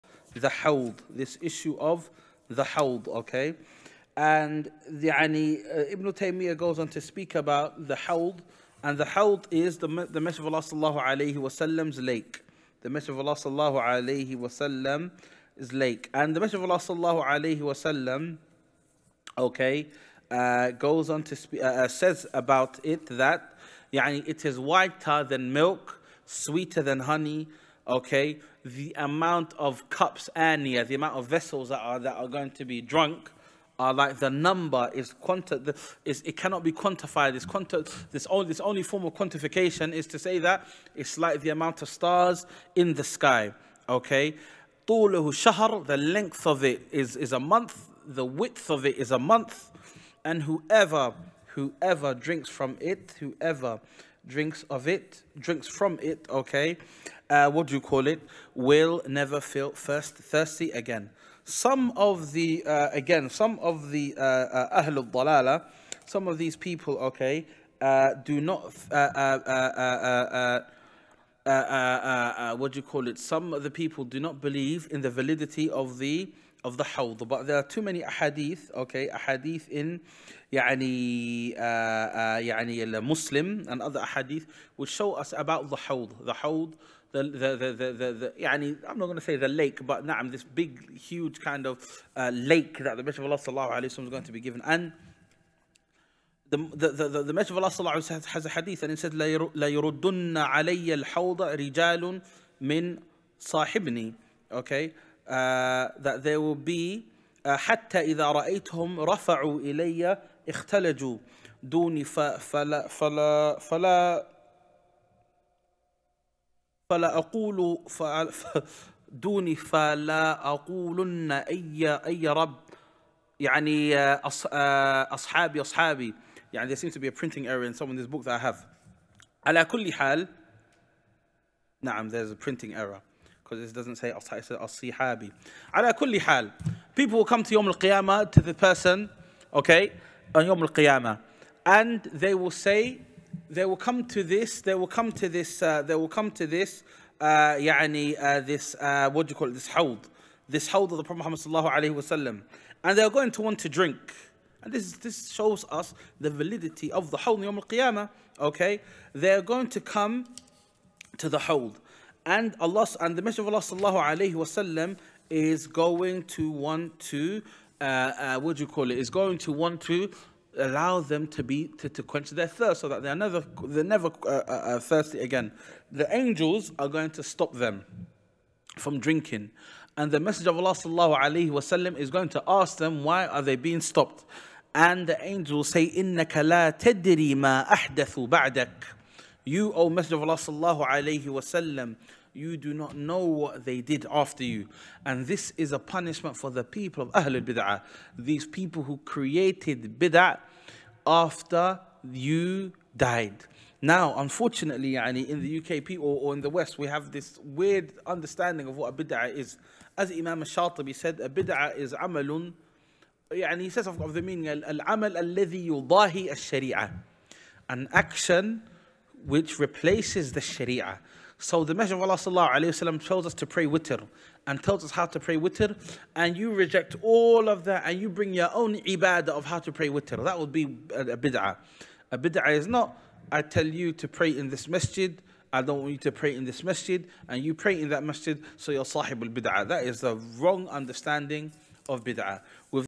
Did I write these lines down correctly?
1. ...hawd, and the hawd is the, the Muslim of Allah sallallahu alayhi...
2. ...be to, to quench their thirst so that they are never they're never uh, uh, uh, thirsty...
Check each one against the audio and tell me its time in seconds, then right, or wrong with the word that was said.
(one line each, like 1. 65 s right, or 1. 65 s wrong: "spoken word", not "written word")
1. 7 s wrong: "Messenger", not "Muslim"
2. 171 s right.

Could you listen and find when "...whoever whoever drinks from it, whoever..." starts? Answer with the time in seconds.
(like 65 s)
50 s.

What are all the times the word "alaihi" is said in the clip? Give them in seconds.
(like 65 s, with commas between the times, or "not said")
164 s, 181 s.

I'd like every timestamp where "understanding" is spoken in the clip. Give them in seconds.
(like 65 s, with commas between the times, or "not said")
208 s, 240 s.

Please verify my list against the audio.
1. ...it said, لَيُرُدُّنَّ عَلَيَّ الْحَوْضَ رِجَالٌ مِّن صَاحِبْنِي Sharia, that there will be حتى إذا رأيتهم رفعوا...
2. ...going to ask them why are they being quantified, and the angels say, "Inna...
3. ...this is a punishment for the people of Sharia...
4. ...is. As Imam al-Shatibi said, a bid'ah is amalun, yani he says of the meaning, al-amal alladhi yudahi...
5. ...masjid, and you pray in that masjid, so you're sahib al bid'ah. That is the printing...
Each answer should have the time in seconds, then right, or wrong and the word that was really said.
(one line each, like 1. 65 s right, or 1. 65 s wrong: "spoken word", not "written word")
1. 98 s wrong: "Okay", not "Sharia"
2. 182 s wrong: "stopped", not "quantified"
3. 195 s wrong: "Ahlul", not "Sharia"
4. 209 s right
5. 236 s wrong: "wrong", not "printing".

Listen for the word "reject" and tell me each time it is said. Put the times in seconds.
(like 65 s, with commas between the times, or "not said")
226 s.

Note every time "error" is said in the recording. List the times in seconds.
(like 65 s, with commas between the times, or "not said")
127 s, 132 s.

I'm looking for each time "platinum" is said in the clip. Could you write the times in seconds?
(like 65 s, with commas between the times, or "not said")
not said.